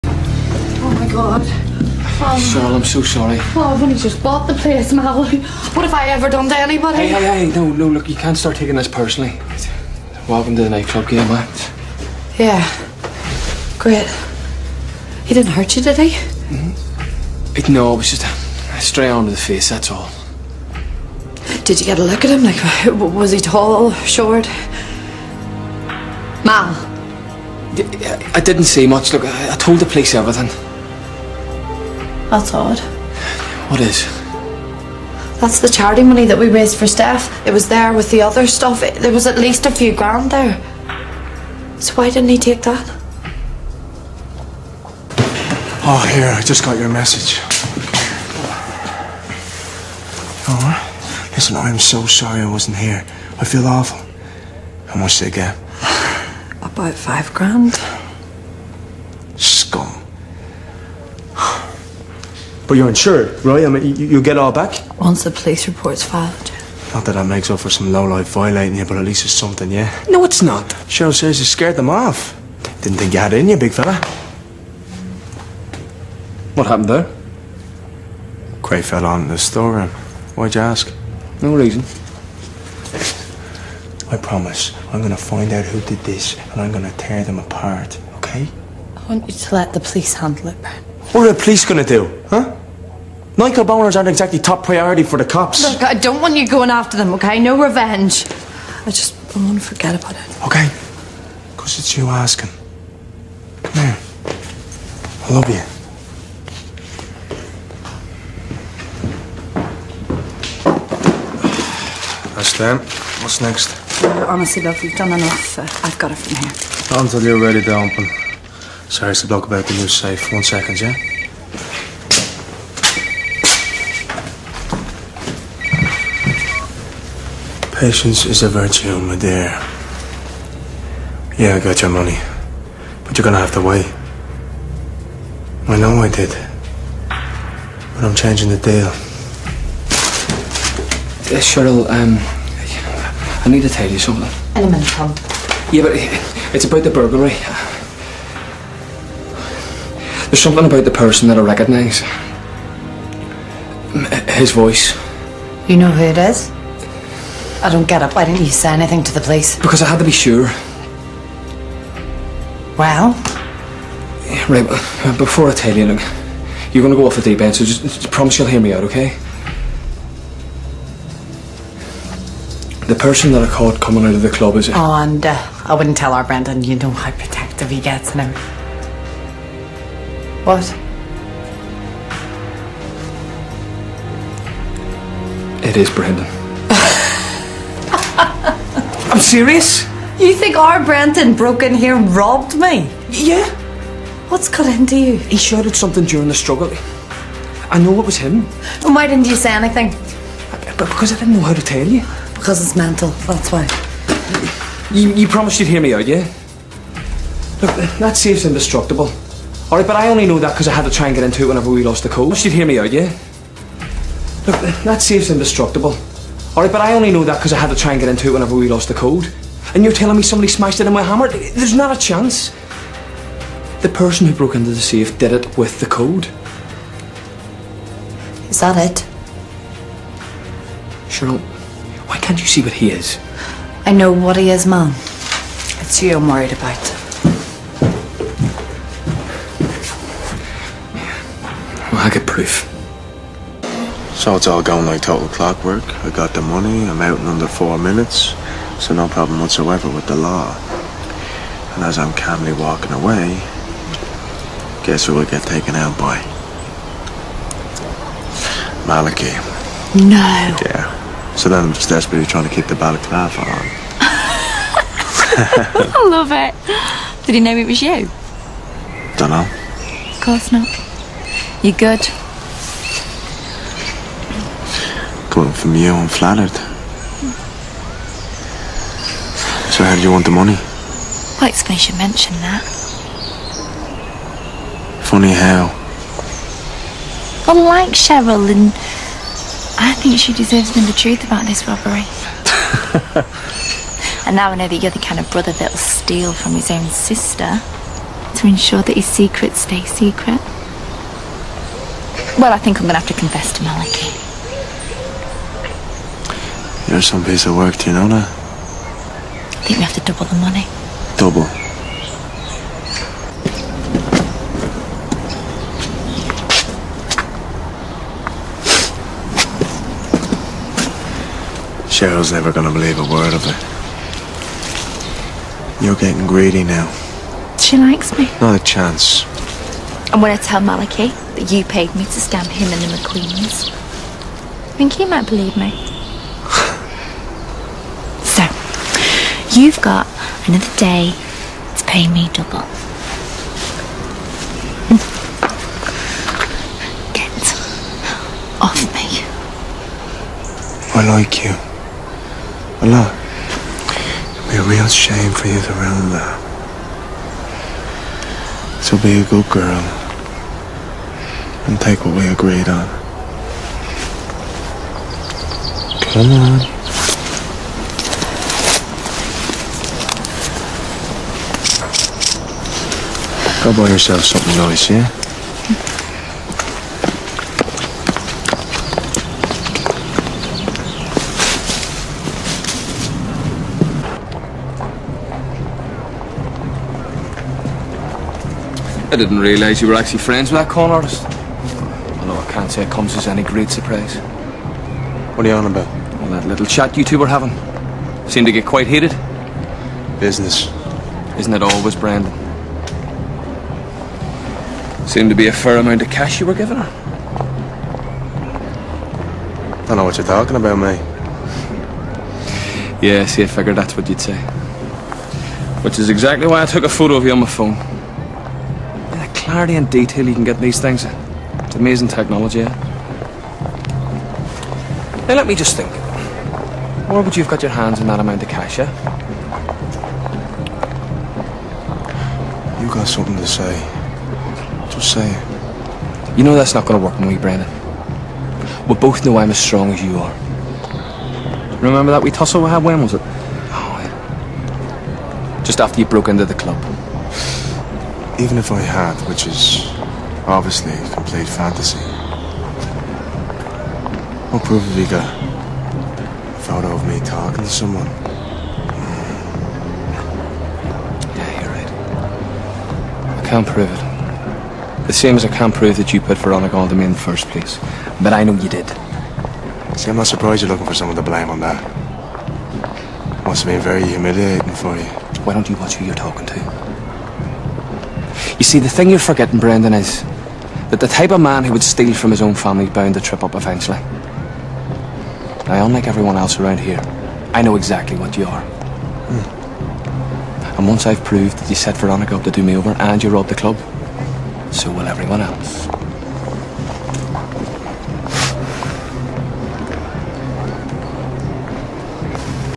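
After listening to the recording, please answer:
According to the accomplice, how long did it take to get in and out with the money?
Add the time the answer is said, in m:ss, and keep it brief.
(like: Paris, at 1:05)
Under 4 minutes, at 4:07.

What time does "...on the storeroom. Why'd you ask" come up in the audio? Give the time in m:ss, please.
1:19.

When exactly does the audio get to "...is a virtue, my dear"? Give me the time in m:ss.
2:08.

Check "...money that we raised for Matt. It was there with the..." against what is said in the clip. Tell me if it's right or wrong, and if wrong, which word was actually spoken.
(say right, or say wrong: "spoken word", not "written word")
wrong: "Steph", not "Matt".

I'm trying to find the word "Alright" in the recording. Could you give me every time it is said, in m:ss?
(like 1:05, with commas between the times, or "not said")
3:29, 3:36.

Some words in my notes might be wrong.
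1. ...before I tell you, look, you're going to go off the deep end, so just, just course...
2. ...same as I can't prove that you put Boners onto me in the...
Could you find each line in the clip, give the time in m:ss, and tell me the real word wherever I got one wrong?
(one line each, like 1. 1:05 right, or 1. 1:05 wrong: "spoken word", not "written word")
1. 2:45 wrong: "promise", not "course"
2. 7:45 wrong: "Veronica", not "Boners".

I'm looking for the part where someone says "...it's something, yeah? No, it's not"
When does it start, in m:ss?
1:09.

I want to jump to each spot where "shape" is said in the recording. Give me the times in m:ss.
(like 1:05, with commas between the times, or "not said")
not said.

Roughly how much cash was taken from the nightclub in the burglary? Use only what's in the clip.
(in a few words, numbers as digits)
About 5 grand.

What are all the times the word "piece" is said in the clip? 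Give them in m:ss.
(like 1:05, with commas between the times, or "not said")
5:07.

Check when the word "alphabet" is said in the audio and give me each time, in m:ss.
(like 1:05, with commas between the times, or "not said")
not said.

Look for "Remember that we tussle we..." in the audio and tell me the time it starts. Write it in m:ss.
7:21.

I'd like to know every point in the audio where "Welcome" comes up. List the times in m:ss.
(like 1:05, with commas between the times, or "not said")
0:10.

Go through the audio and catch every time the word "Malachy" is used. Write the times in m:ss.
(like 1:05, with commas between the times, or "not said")
4:18, 5:03, 5:30.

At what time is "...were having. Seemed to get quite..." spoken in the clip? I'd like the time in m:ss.
6:37.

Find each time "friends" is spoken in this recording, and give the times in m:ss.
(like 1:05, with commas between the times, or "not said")
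6:30.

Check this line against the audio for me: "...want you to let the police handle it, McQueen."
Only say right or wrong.
wrong.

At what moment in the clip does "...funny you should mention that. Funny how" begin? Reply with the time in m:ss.
4:41.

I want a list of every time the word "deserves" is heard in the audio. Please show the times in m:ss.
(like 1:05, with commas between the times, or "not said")
4:50.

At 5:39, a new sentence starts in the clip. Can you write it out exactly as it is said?
You've got another day to pay me double.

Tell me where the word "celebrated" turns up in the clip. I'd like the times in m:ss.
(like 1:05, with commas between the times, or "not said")
not said.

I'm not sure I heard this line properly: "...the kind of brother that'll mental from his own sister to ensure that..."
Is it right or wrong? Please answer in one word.
wrong.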